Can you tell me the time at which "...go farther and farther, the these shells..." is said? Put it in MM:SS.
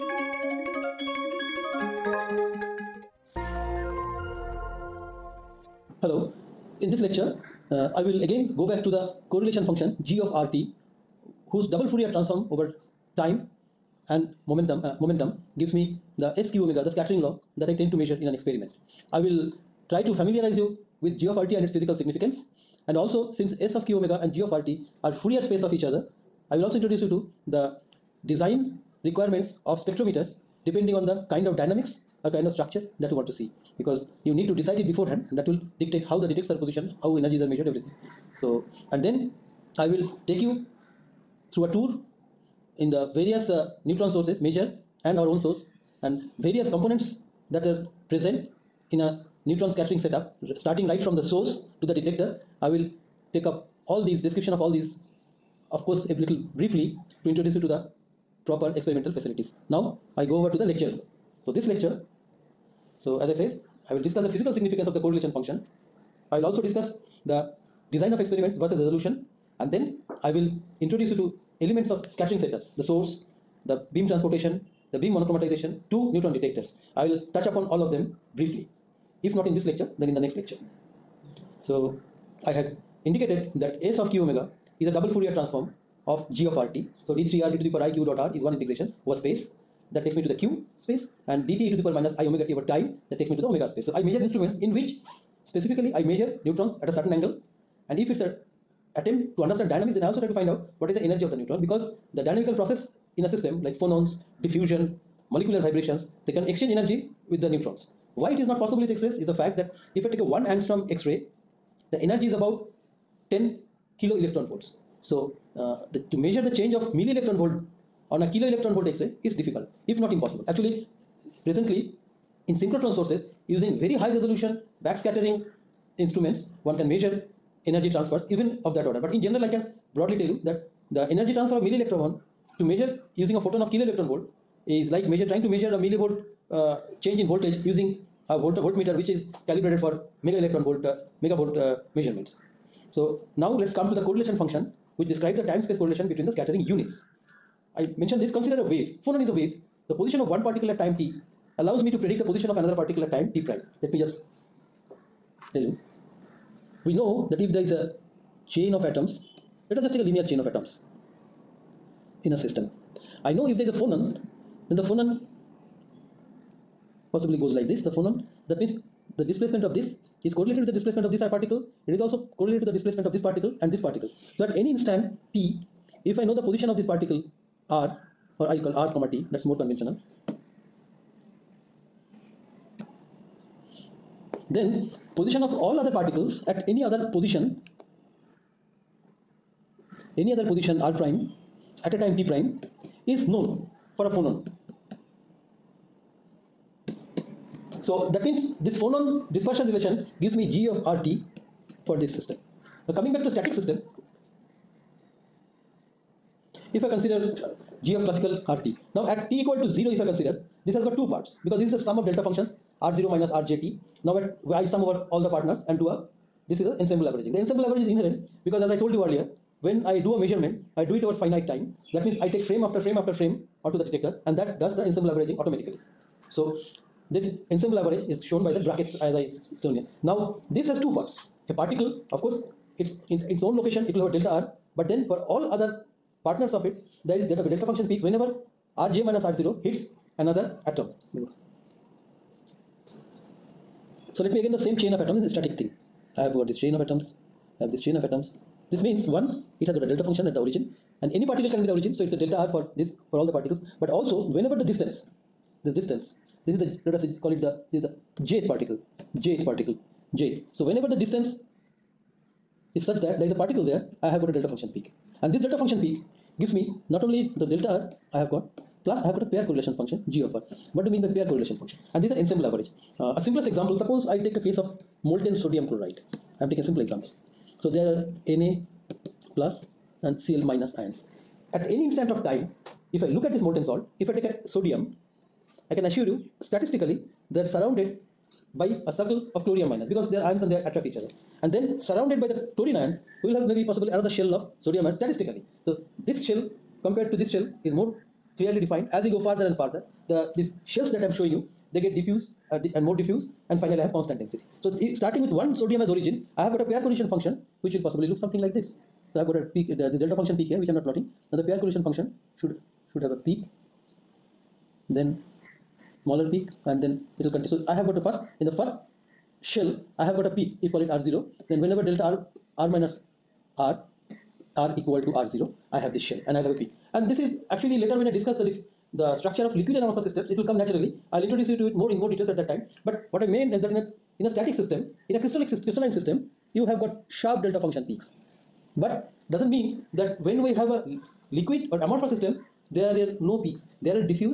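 04:59.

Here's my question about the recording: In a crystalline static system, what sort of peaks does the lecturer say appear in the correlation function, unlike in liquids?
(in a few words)
Sharp delta function peaks.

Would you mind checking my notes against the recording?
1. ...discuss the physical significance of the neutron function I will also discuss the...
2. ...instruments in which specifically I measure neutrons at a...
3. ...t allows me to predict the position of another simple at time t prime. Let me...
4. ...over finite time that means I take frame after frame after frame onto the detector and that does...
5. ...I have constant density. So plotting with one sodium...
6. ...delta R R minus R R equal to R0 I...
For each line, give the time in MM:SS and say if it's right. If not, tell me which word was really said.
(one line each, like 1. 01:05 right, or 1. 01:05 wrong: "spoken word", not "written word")
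1. 01:04 wrong: "correlation", not "neutron"
2. 01:34 right
3. 02:30 wrong: "particle", not "simple"
4. 03:41 right
5. 05:03 wrong: "starting", not "plotting"
6. 05:21 right.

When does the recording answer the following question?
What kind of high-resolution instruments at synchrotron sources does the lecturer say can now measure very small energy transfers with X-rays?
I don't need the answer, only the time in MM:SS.
02:04.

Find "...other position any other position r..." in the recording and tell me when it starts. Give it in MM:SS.
03:06.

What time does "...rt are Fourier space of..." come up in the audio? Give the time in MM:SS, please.
00:24.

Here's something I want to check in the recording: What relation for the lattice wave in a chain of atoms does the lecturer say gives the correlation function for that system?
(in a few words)
Phonon dispersion relation.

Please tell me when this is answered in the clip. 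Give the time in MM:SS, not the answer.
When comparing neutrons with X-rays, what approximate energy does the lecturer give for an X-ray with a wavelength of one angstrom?
01:52.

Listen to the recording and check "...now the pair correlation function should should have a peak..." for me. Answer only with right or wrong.
right.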